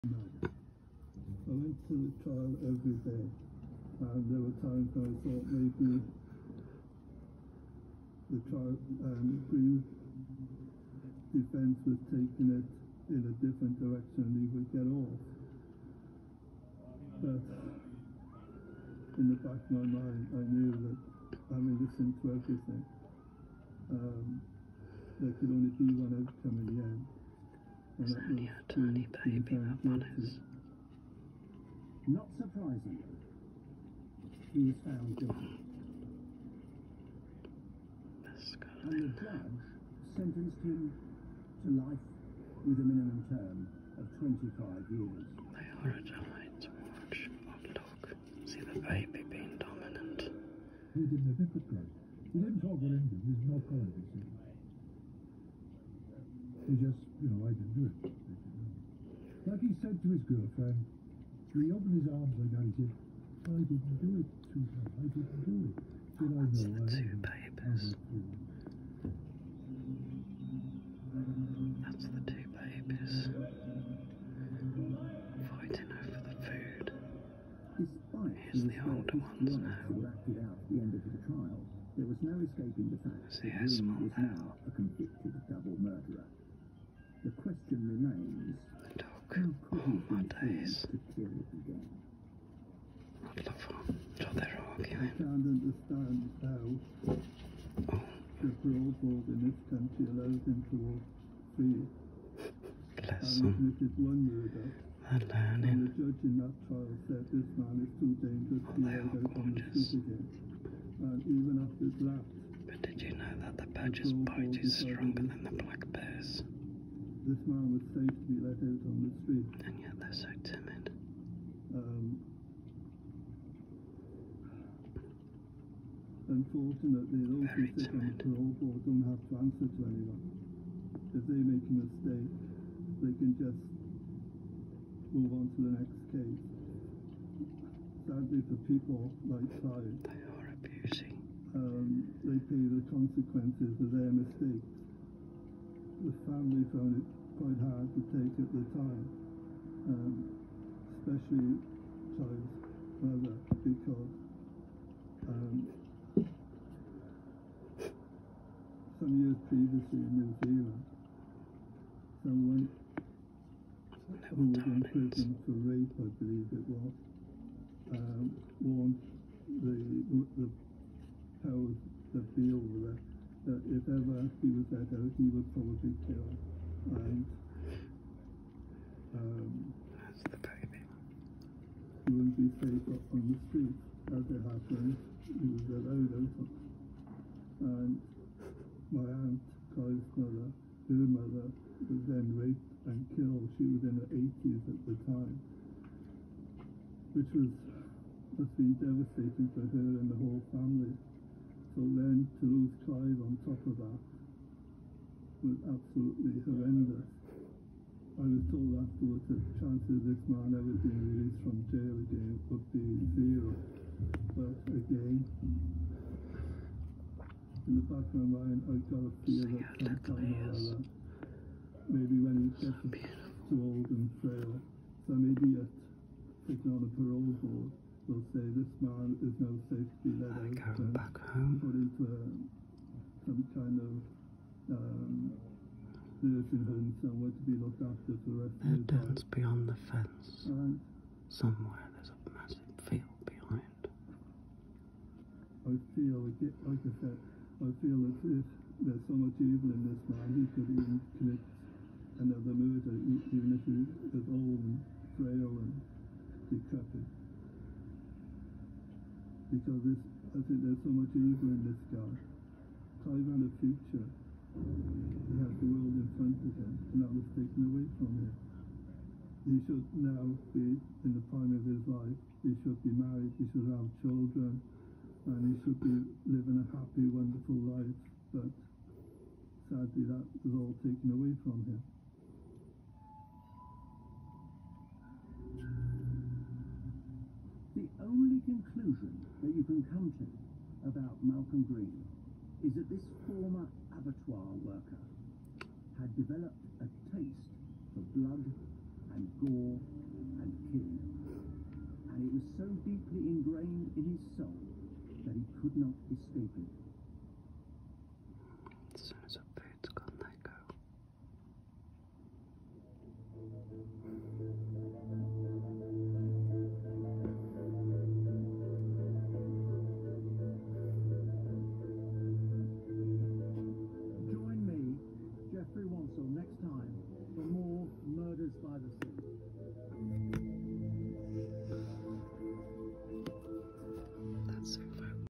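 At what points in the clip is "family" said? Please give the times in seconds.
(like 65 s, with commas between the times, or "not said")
146 s, 200 s.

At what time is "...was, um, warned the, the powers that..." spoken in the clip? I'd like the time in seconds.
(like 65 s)
166 s.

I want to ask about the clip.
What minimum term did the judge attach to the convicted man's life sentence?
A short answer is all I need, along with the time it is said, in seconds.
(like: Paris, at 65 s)
25 years, at 44 s.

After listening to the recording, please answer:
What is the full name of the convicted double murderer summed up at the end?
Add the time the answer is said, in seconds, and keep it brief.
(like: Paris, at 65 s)
Malcolm Green, at 291 s.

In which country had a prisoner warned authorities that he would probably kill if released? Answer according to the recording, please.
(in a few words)
New Zealand.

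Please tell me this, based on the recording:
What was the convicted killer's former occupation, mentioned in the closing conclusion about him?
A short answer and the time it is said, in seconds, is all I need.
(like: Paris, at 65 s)
Abattoir worker, at 293 s.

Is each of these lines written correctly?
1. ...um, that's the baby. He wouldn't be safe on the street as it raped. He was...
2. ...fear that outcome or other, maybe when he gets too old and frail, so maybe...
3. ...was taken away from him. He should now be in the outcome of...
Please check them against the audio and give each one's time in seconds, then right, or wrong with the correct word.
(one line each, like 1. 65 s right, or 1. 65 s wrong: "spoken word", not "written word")
1. 179 s wrong: "happened", not "raped"
2. 219 s wrong: "sometime", not "outcome"
3. 267 s wrong: "prime", not "outcome".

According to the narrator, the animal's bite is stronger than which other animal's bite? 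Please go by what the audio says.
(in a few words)
Black bear.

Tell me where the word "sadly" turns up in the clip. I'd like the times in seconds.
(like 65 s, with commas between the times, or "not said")
138 s, 279 s.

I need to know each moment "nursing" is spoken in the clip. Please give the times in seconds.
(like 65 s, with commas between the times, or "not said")
236 s.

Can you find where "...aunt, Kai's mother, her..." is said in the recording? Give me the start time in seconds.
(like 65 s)
189 s.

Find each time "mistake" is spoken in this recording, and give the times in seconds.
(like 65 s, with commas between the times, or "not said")
131 s, 144 s.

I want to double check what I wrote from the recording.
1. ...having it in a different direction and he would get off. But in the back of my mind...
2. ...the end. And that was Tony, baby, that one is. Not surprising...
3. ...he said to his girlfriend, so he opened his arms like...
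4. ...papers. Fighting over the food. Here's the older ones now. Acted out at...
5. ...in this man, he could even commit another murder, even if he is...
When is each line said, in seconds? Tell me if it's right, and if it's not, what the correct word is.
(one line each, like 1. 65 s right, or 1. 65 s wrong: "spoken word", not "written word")
1. 12 s wrong: "taking", not "having"
2. 26 s right
3. 59 s right
4. 72 s right
5. 249 s right.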